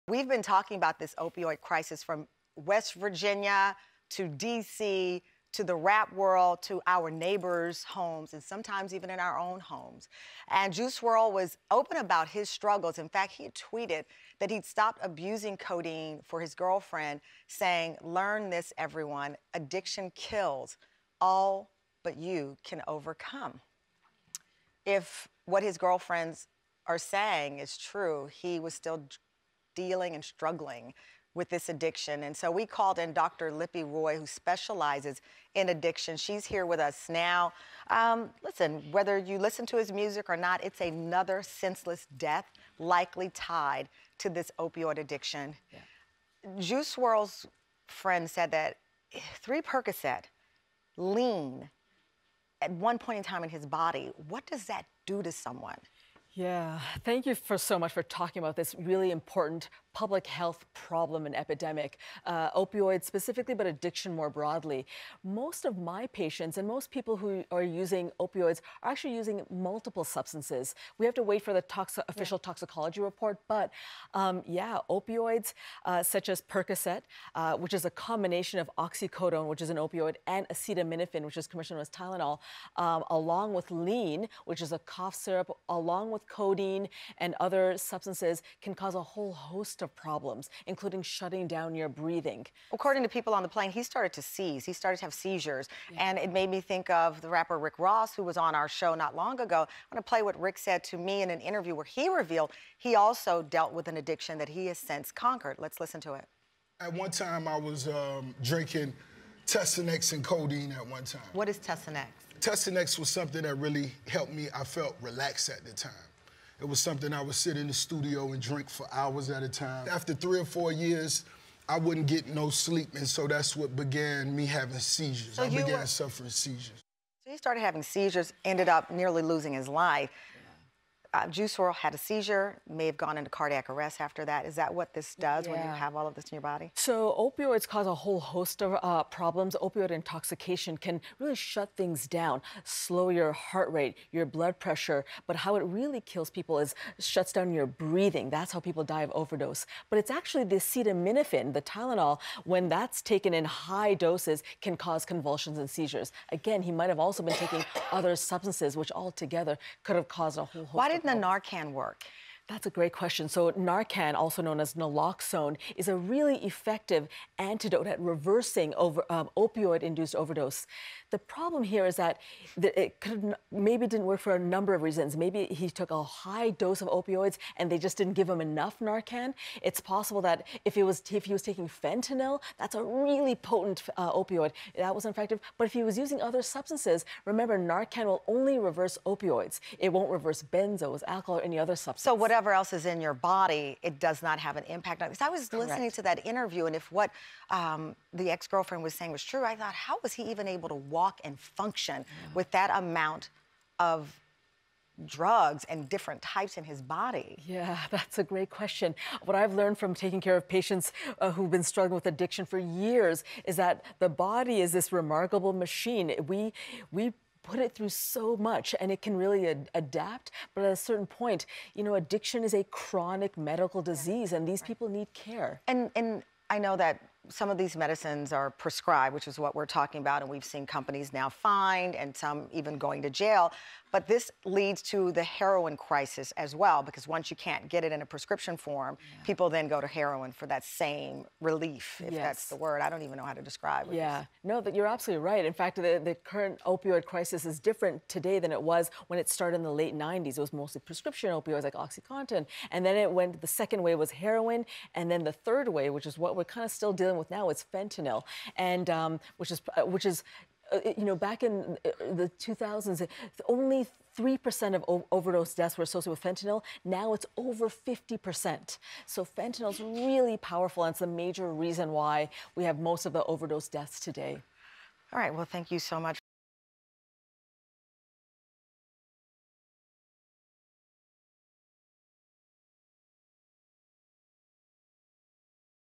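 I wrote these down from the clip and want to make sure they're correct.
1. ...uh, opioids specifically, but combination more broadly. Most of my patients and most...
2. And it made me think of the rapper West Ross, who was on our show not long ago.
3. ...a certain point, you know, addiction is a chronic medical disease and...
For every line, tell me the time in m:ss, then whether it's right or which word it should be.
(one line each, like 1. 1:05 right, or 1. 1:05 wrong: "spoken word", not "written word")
1. 1:02 wrong: "addiction", not "combination"
2. 1:36 wrong: "Rick", not "West"
3. 3:40 right.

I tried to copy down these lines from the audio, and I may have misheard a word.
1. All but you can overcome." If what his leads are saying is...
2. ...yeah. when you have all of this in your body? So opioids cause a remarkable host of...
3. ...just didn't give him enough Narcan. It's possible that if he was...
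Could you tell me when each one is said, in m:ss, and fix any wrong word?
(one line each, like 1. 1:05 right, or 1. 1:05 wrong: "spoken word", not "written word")
1. 0:21 wrong: "girlfriends", not "leads"
2. 2:15 wrong: "whole", not "remarkable"
3. 2:57 right.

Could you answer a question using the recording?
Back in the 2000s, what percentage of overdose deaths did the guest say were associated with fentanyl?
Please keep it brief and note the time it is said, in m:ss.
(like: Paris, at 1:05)
3%, at 4:24.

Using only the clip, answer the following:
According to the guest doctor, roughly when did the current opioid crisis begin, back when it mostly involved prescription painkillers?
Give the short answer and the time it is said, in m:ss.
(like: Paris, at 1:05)
Late 90s, at 4:09.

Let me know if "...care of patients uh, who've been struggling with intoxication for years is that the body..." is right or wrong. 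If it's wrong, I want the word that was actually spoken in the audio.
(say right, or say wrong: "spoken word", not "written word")
wrong: "addiction", not "intoxication".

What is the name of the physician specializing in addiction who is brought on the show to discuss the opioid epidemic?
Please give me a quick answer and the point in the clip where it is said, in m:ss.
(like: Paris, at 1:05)
Dr. Lipi Roy, at 0:33.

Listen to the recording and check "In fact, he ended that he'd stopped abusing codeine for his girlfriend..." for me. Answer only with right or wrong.
wrong.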